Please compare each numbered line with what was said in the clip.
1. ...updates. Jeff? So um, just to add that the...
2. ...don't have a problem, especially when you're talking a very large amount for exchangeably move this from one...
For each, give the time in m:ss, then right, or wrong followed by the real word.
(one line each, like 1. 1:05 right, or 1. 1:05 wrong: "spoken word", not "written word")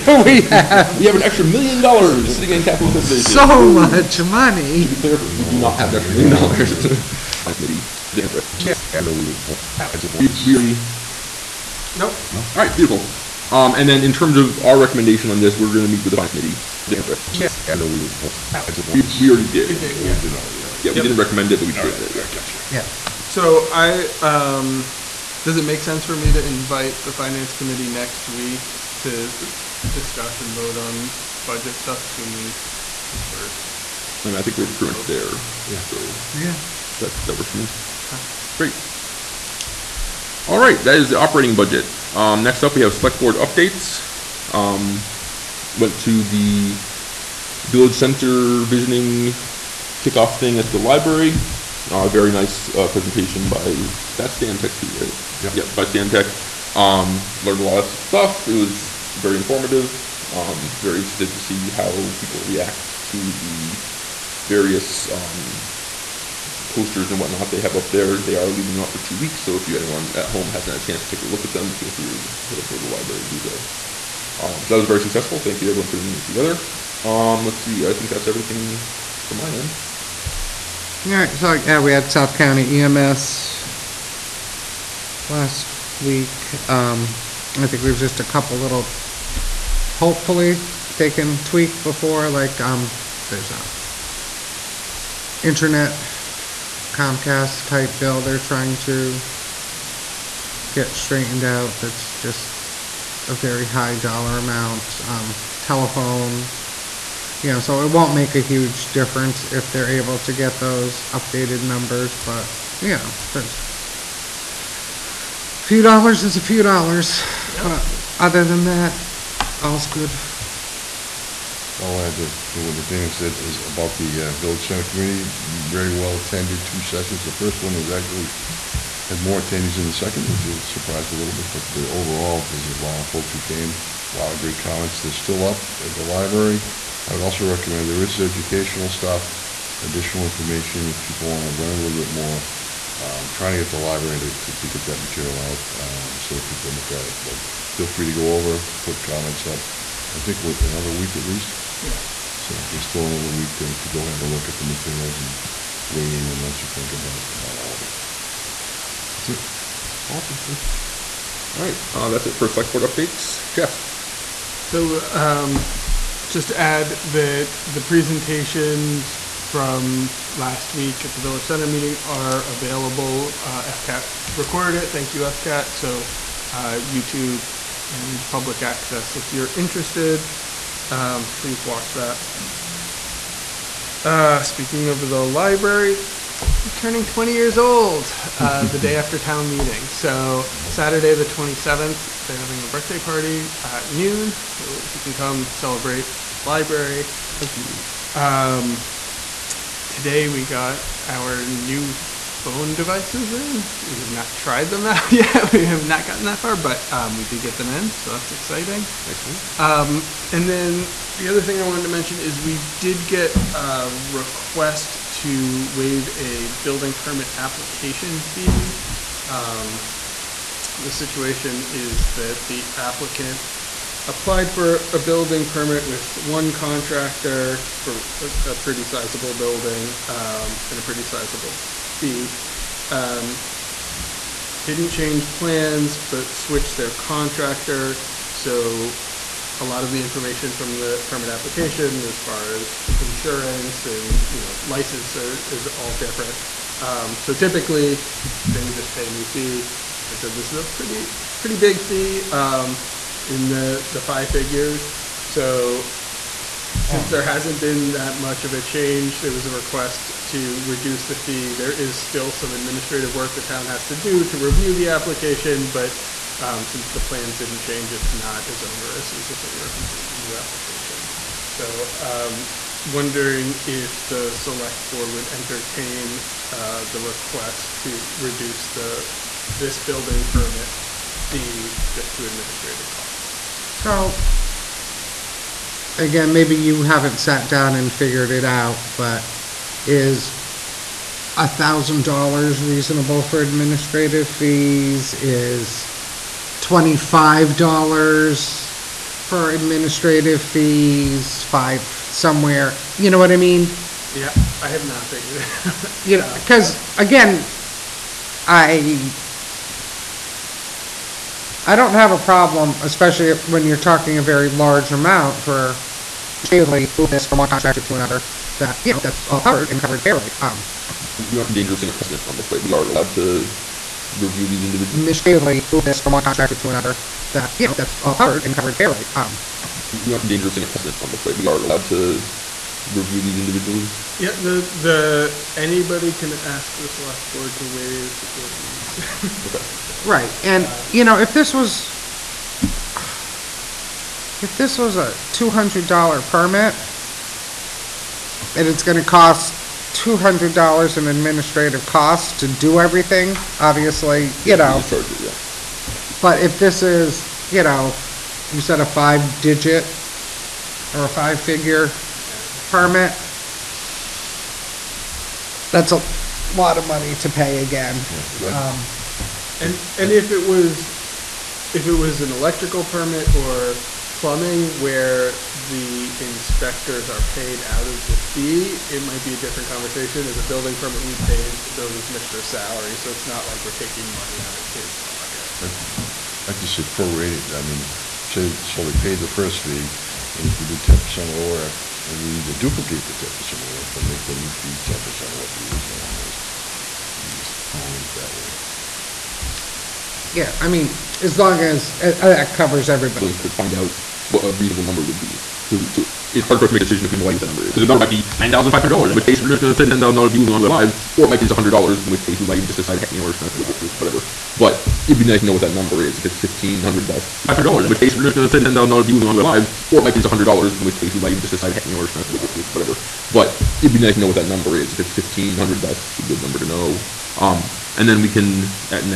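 1. 2:42 right
2. 5:11 right.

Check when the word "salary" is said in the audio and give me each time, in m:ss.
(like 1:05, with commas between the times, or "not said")
6:22.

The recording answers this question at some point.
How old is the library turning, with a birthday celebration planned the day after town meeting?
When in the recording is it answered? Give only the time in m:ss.
3:07.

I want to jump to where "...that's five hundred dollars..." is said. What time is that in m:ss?
6:57.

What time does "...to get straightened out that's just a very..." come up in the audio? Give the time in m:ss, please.
1:38.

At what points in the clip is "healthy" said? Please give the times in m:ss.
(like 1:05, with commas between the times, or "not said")
not said.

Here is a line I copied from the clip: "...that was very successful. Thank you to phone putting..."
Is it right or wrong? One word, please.
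wrong.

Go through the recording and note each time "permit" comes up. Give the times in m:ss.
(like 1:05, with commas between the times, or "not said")
3:36, 3:45, 4:01, 4:40, 5:46, 6:02, 6:12, 6:20.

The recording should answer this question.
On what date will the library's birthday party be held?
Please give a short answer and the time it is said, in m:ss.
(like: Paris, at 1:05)
Saturday the 27th, at 3:10.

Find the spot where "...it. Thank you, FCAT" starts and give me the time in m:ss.
2:54.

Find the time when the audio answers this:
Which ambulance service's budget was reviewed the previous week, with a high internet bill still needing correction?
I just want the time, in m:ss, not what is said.
1:22.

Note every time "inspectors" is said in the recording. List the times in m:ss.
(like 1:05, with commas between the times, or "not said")
6:16.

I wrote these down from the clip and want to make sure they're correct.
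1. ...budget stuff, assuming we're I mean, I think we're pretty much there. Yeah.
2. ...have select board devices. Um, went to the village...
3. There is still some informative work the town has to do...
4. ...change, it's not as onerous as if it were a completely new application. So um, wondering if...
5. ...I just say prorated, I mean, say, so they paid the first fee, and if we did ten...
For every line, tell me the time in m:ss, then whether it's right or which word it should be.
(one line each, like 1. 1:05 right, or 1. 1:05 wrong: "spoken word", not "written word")
1. 0:31 right
2. 0:42 wrong: "updates", not "devices"
3. 4:21 wrong: "administrative", not "informative"
4. 4:27 right
5. 6:26 right.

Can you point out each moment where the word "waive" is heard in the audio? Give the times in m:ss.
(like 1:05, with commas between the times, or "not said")
3:35, 5:37.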